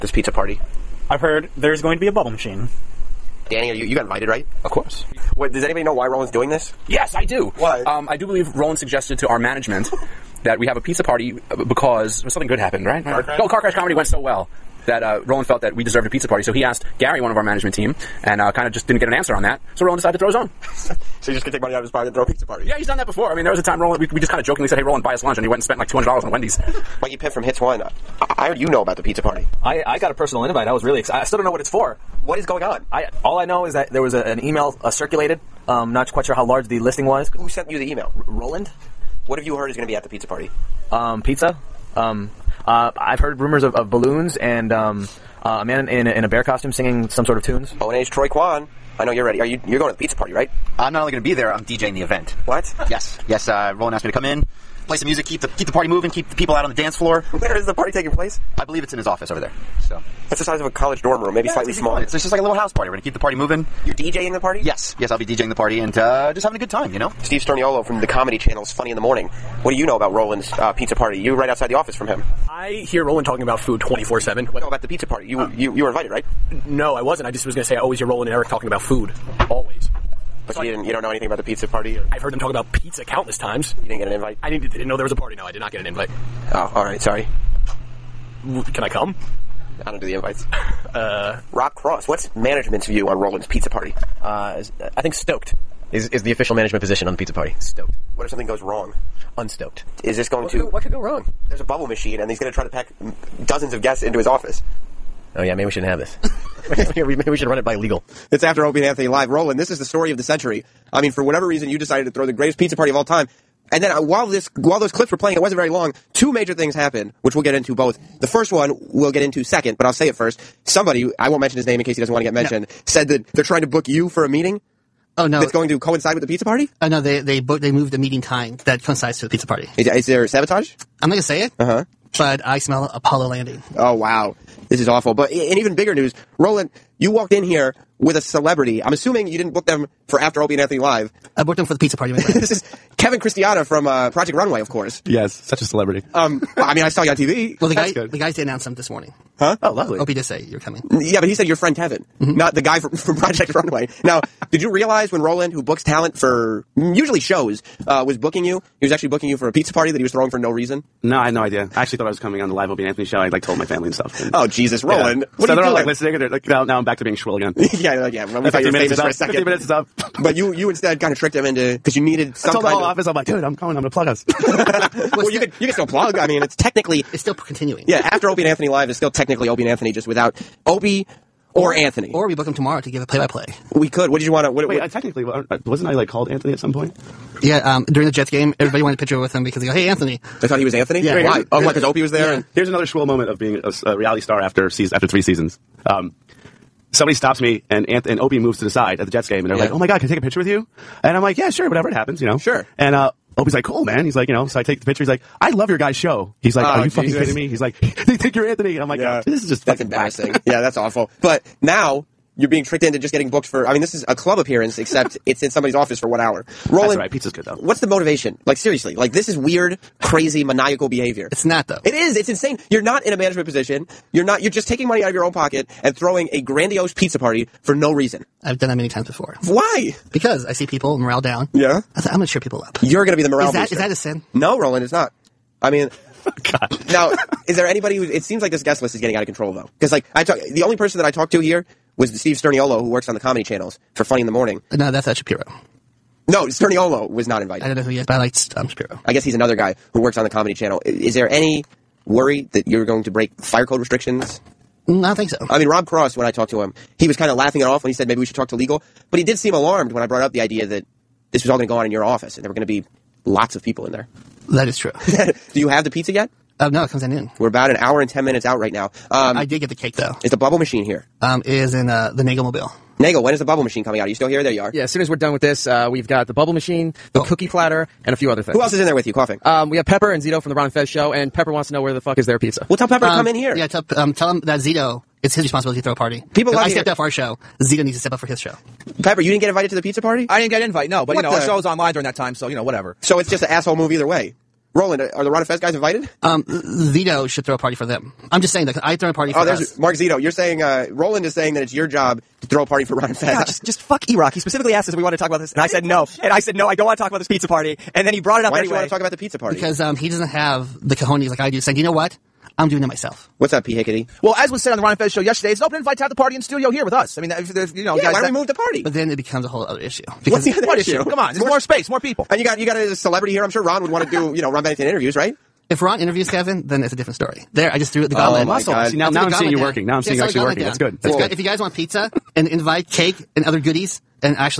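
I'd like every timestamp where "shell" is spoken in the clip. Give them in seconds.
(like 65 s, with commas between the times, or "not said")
not said.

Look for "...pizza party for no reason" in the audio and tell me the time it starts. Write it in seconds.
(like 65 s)
226 s.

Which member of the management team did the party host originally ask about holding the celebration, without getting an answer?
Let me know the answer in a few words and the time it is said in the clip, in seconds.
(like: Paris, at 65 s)
Gary, at 16 s.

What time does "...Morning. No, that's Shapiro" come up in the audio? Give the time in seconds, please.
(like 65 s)
244 s.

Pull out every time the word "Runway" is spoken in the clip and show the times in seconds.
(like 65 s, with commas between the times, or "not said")
144 s, 153 s.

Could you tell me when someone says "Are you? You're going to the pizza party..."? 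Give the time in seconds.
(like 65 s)
49 s.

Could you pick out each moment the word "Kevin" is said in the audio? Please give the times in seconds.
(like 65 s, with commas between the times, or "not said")
142 s, 151 s, 326 s.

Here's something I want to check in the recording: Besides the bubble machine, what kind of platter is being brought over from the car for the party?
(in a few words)
cookie platter.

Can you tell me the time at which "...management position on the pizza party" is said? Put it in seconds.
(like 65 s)
96 s.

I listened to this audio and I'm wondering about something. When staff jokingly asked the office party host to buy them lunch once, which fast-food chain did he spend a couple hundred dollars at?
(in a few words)
Wendy's.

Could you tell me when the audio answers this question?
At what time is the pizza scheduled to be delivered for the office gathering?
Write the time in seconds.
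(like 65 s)
267 s.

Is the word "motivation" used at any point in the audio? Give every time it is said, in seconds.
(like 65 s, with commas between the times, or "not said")
217 s.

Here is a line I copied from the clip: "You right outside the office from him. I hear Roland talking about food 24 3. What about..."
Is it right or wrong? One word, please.
wrong.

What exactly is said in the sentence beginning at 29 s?
I I got a personal invite.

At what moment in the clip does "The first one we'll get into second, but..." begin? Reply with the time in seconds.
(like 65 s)
118 s.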